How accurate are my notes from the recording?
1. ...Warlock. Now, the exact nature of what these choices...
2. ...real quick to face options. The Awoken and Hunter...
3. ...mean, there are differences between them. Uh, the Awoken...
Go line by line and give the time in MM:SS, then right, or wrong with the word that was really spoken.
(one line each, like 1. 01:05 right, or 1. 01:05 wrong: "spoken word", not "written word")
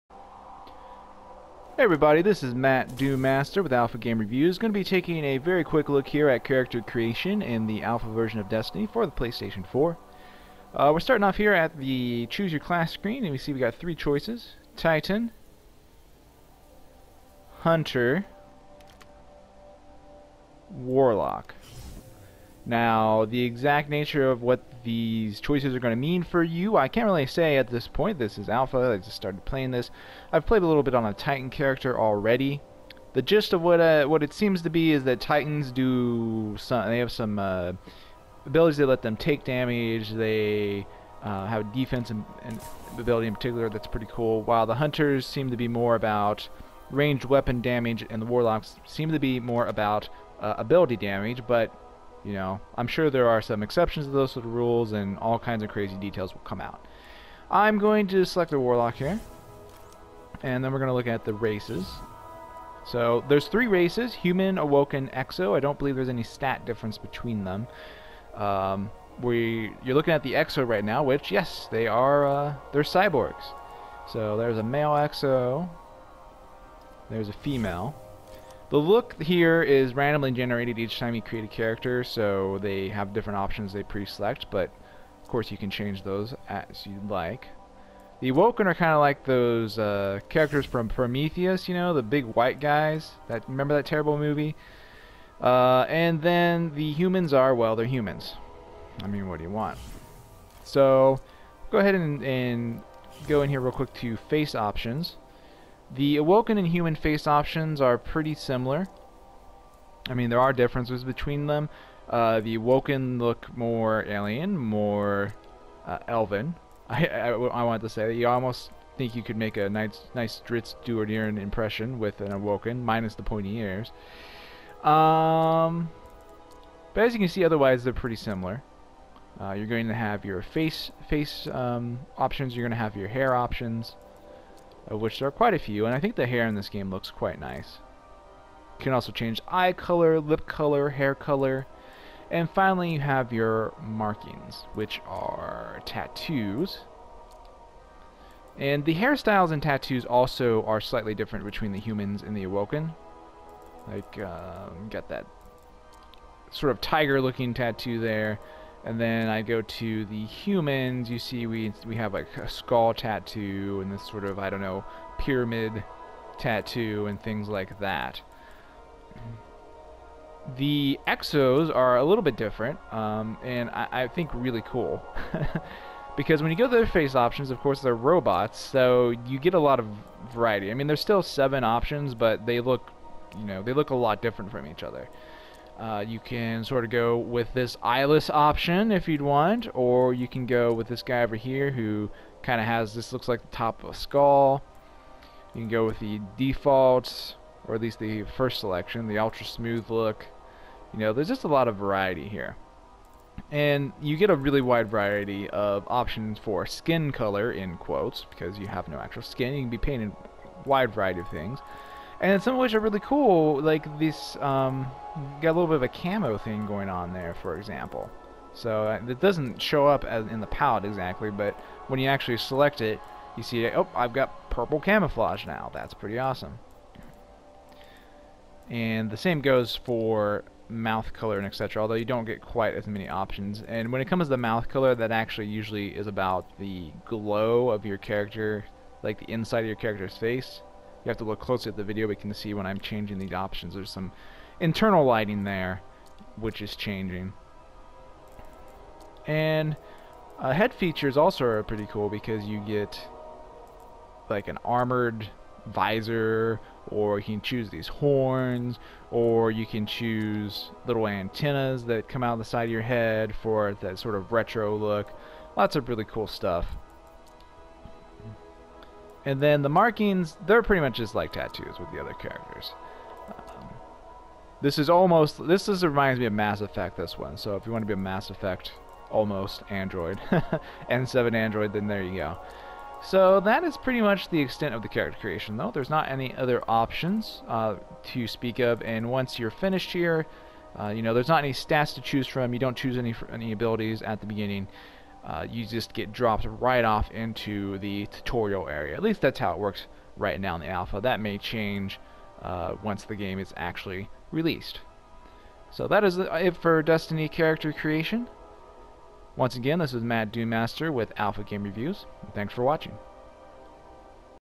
1. 00:20 right
2. 01:43 wrong: "Human", not "Hunter"
3. 01:50 right.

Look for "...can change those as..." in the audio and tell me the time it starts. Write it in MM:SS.
01:25.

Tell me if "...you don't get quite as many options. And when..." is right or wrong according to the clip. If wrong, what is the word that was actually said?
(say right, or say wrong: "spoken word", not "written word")
right.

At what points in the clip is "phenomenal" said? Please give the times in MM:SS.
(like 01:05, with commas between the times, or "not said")
not said.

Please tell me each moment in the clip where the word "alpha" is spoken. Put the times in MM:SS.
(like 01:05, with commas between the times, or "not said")
00:03, 00:07, 00:28, 05:00, 05:11.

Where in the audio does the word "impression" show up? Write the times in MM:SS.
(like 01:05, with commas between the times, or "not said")
02:01.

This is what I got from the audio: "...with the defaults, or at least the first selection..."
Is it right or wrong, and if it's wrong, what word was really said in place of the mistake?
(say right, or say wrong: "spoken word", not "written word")
right.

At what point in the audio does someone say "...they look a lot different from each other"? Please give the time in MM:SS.
03:03.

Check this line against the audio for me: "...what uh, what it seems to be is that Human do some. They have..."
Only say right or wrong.
wrong.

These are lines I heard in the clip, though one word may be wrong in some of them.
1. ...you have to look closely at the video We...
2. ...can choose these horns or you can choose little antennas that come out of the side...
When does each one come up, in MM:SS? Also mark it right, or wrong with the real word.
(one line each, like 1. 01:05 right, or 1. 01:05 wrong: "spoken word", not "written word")
1. 04:01 right
2. 04:17 right.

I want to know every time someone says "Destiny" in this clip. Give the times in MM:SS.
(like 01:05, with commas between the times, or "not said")
00:08, 05:06.